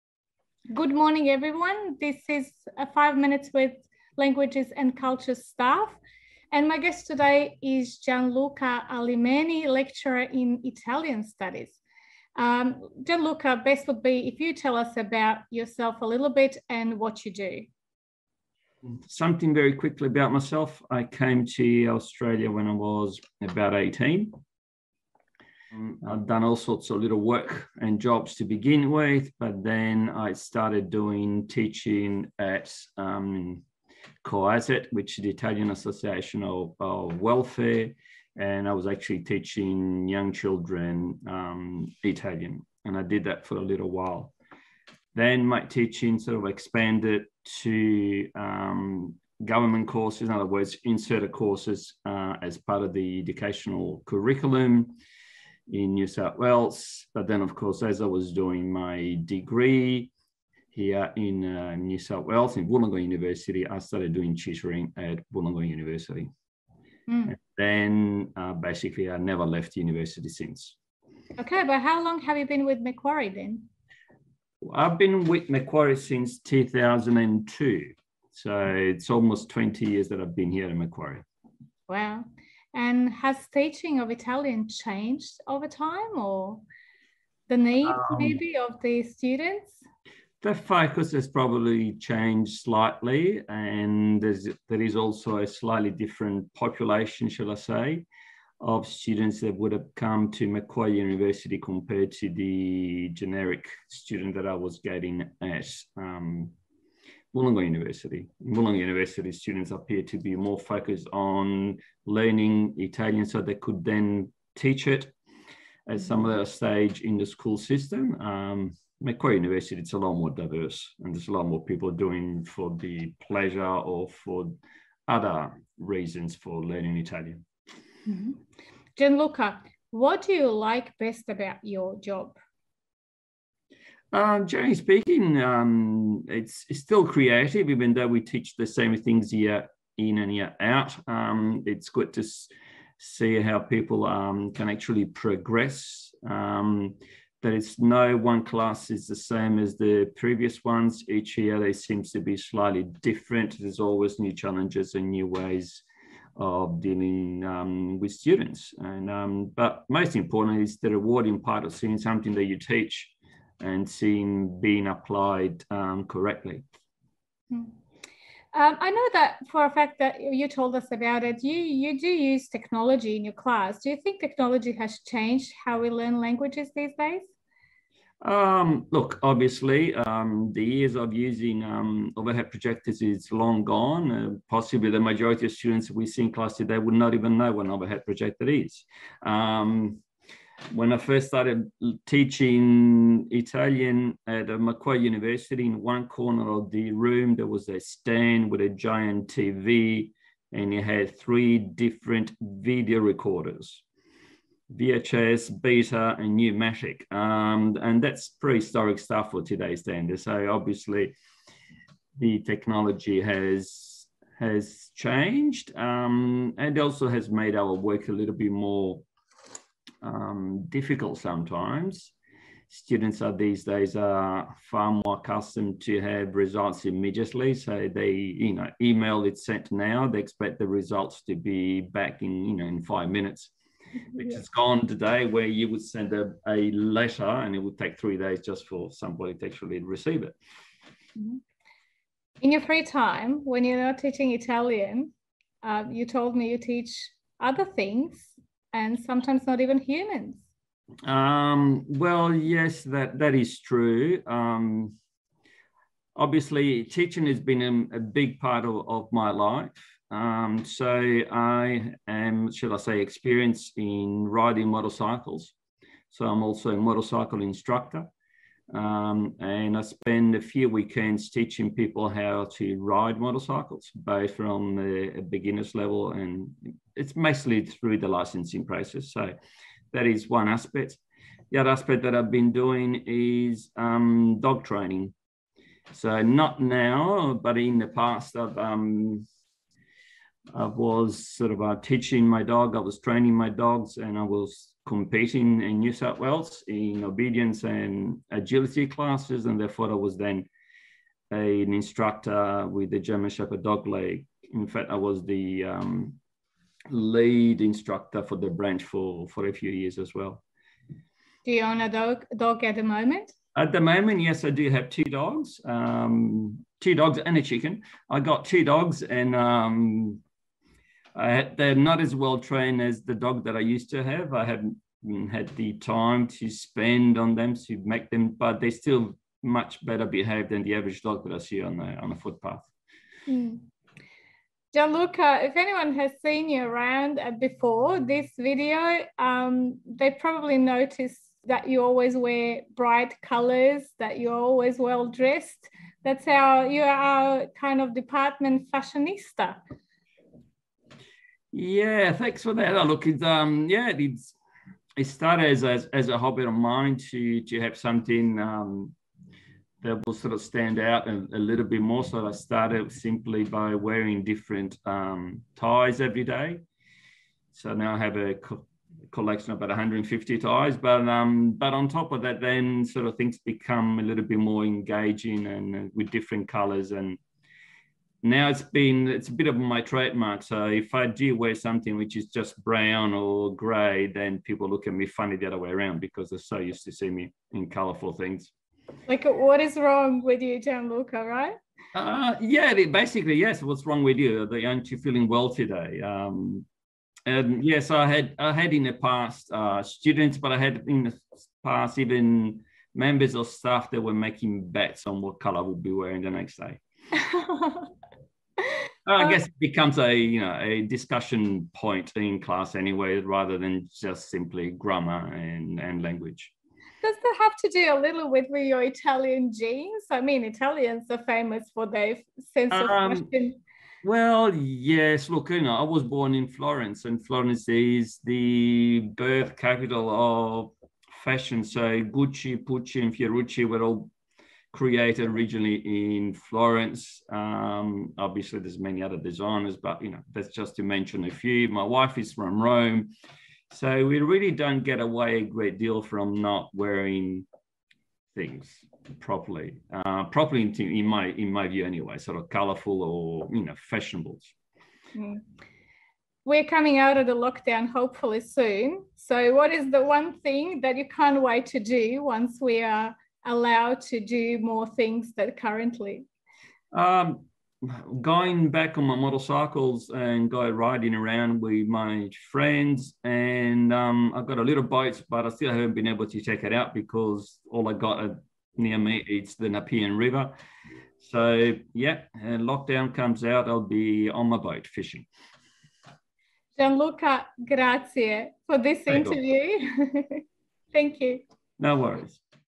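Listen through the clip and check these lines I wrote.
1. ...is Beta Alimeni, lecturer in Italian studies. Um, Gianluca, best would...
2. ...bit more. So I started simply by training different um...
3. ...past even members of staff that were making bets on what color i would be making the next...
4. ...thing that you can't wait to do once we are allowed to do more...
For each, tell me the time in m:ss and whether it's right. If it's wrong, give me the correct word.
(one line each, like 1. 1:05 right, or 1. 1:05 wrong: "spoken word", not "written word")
1. 0:07 wrong: "Gianluca", not "Beta"
2. 6:01 wrong: "wearing", not "training"
3. 6:41 wrong: "wearing", not "making"
4. 7:40 right.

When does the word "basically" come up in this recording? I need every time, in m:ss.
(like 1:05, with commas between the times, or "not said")
1:08, 6:32.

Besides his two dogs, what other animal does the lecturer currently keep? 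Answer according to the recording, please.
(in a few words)
A chicken.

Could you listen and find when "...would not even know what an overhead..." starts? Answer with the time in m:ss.
3:06.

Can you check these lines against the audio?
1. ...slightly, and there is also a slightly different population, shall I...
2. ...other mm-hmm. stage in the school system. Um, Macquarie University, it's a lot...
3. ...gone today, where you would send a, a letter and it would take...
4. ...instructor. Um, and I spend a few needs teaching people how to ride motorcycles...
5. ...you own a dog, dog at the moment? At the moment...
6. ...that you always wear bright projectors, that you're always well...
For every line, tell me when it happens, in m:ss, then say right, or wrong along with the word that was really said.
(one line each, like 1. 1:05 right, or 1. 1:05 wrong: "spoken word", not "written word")
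1. 1:32 right
2. 1:56 right
3. 3:54 right
4. 4:27 wrong: "weekends", not "needs"
5. 5:11 right
6. 5:41 wrong: "colors", not "projectors".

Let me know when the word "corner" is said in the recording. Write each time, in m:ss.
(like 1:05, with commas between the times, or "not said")
3:16.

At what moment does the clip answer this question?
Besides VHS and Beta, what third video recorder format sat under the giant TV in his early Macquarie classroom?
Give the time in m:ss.
3:26.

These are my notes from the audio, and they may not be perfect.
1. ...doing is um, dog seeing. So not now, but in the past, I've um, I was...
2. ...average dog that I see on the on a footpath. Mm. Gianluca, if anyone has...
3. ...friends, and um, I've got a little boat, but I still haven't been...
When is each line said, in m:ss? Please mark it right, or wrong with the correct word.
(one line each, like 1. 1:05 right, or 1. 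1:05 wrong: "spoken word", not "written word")
1. 4:42 wrong: "training", not "seeing"
2. 5:30 right
3. 7:52 right.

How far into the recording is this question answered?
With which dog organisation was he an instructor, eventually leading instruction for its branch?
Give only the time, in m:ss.
5:02.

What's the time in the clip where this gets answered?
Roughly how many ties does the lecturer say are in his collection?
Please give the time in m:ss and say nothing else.
6:09.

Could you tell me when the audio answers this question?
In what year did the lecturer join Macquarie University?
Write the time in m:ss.
1:16.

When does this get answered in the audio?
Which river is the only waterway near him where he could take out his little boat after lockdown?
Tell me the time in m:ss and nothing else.
7:59.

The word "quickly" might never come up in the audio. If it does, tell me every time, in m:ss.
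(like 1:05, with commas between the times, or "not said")
0:19.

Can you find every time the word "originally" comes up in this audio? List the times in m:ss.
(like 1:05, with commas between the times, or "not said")
7:15.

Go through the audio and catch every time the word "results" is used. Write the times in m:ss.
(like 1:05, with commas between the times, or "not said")
3:46, 3:50.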